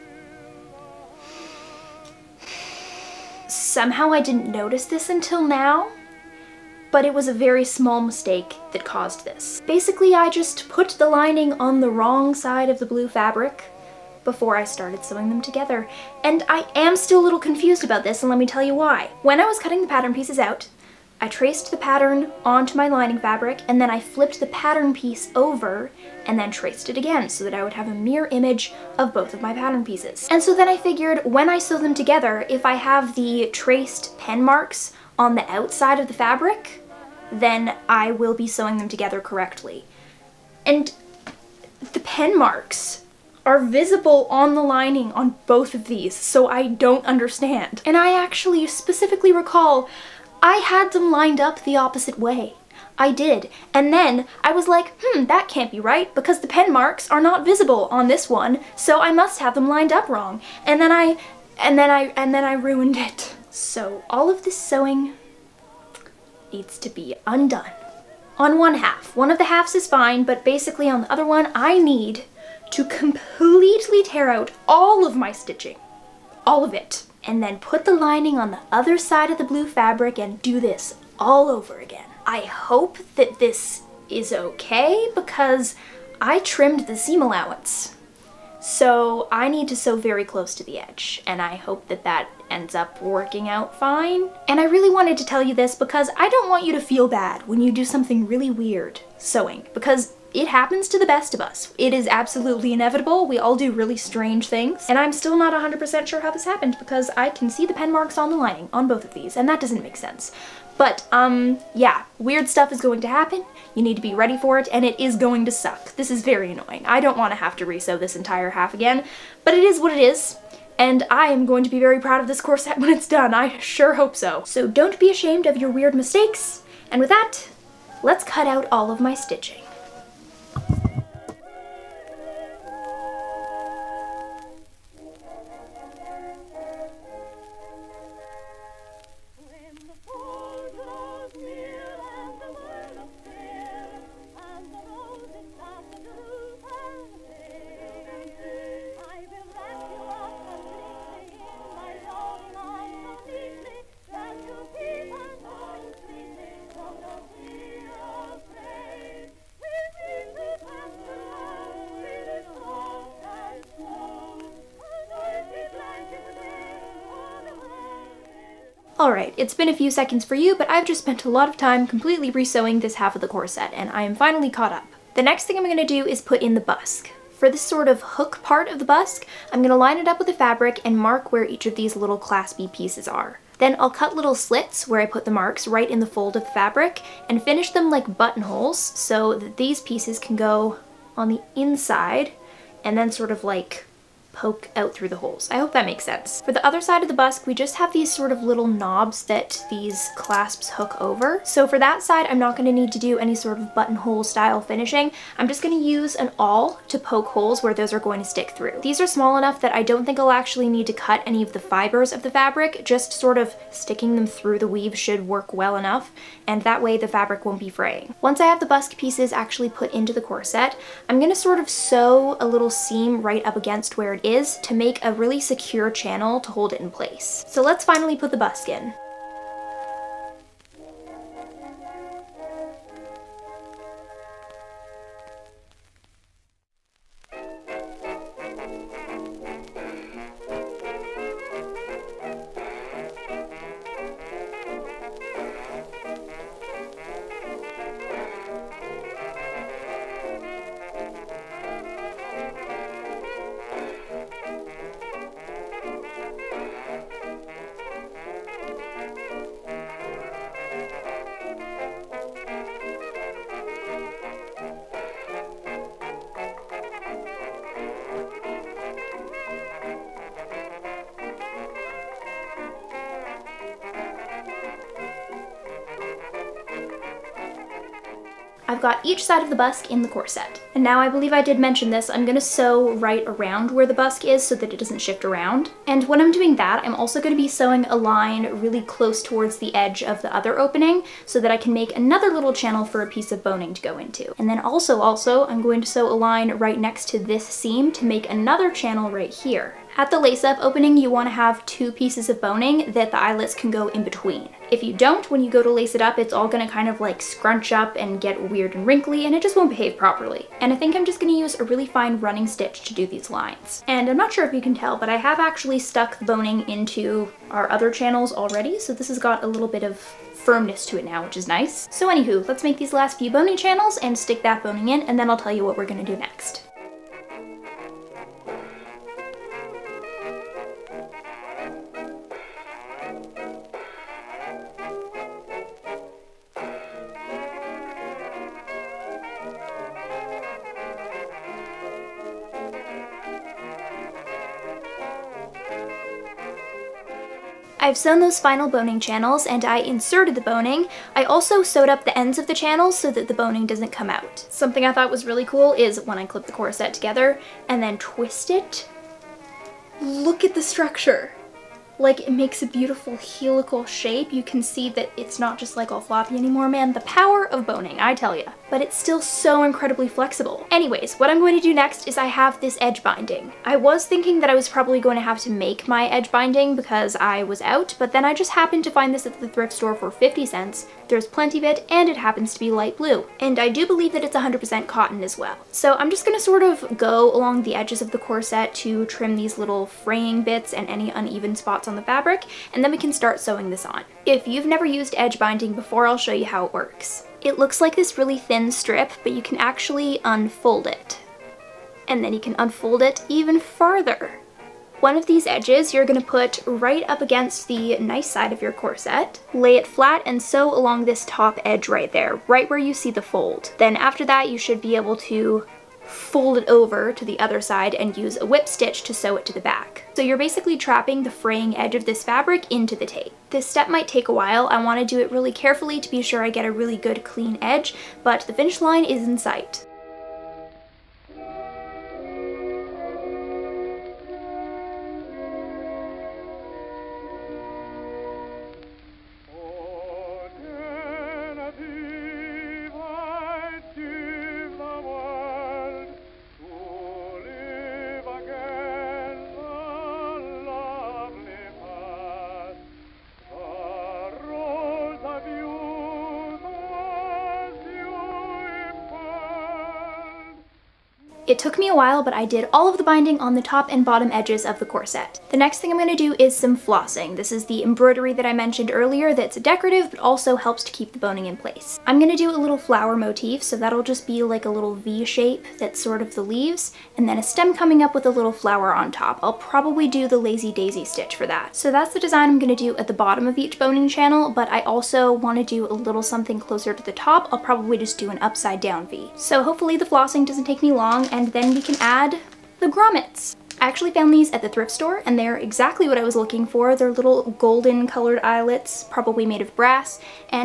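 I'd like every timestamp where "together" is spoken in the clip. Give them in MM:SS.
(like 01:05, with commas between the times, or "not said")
00:15, 00:31, 00:38, 05:56.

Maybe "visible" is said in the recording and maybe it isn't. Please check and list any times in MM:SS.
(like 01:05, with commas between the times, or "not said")
00:43, 00:57.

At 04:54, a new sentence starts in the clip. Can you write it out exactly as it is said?
And then also, also, I'm going to sew a line right next to this seam to make another channel right here.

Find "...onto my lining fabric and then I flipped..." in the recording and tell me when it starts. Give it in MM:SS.
00:22.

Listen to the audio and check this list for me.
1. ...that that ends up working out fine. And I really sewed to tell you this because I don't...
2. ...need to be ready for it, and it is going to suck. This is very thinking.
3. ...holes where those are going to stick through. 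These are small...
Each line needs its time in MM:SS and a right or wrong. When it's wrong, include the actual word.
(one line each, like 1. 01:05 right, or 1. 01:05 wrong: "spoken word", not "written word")
1. 01:31 wrong: "wanted", not "sewed"
2. 01:53 wrong: "annoying", not "thinking"
3. 03:27 right.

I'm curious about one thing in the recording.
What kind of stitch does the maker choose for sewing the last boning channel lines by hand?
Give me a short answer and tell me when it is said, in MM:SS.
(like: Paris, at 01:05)
fine running stitch, at 05:11.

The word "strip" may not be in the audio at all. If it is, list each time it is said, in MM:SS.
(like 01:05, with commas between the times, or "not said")
06:38.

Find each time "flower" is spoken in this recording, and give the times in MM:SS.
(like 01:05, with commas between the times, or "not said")
07:52, 07:58.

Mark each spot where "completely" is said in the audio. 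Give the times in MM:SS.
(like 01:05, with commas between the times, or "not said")
01:12, 02:51.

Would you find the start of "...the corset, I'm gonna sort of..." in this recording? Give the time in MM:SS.
03:40.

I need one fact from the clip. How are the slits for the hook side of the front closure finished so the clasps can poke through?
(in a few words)
like buttonholes.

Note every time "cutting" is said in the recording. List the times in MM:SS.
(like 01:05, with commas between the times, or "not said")
00:19.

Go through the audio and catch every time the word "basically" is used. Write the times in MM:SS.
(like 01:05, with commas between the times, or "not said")
00:09, 01:10, 07:00.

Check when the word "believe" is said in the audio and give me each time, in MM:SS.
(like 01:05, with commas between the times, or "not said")
04:41, 06:23.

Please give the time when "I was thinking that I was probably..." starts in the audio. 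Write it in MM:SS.
06:13.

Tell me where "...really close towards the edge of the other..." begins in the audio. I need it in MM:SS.
04:48.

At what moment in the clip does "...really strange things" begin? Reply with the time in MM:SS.
01:43.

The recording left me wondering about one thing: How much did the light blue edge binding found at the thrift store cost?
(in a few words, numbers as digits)
50 cents.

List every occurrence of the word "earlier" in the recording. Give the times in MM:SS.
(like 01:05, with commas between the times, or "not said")
07:48.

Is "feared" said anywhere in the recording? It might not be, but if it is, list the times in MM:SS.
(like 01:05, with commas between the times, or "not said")
not said.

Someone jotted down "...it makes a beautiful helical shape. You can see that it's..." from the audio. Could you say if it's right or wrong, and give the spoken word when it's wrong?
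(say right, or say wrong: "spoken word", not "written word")
right.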